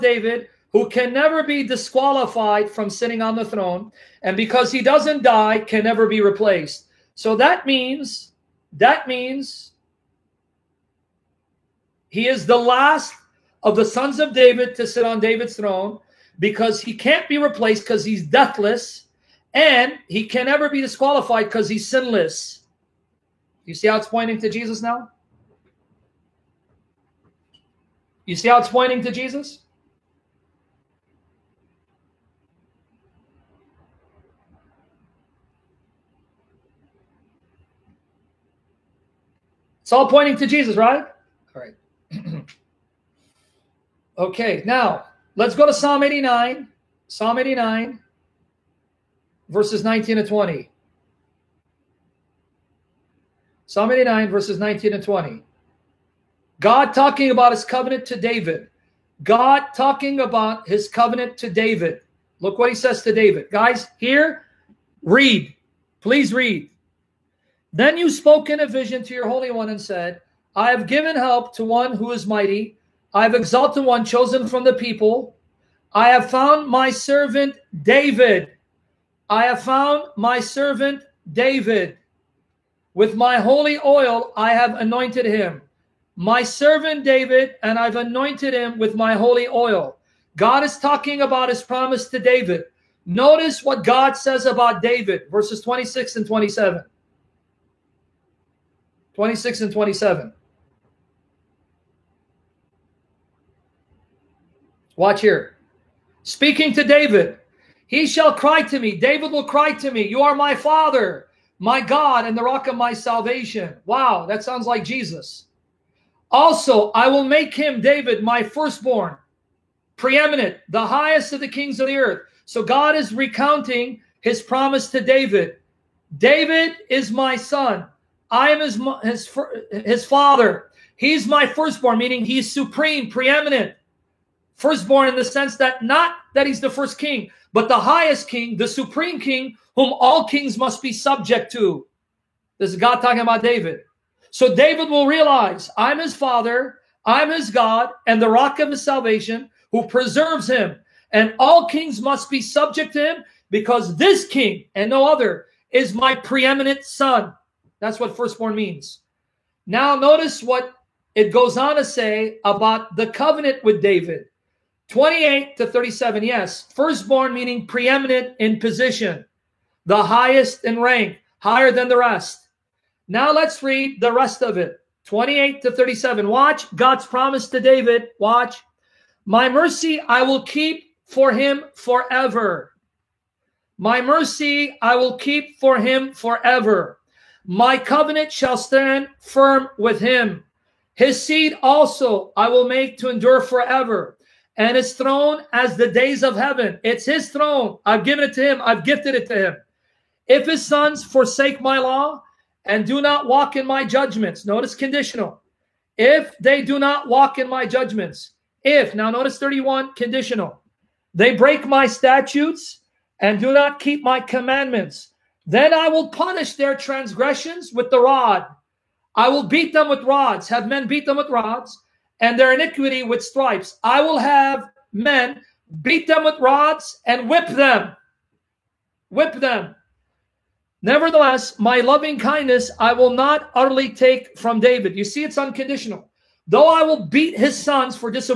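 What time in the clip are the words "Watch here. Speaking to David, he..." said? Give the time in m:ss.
1:44.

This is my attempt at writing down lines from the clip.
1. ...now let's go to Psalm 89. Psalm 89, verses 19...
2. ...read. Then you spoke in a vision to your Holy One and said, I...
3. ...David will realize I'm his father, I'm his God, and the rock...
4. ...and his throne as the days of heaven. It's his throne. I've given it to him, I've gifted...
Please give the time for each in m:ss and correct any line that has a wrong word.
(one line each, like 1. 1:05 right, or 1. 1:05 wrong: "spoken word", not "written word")
1. 0:44 right
2. 1:06 right
3. 2:24 right
4. 3:14 right.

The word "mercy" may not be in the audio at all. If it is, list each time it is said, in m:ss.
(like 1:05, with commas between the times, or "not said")
2:59, 3:04.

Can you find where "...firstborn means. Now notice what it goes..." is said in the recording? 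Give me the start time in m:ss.
2:38.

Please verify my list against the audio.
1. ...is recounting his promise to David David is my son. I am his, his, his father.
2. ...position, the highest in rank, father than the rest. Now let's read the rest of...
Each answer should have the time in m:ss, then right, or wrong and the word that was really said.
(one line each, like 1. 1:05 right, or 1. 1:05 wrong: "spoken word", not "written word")
1. 2:02 right
2. 2:48 wrong: "higher", not "father".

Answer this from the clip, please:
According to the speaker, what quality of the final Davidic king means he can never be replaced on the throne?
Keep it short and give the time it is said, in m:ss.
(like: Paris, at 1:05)
Deathless, at 0:18.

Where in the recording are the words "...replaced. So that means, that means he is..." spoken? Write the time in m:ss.
0:06.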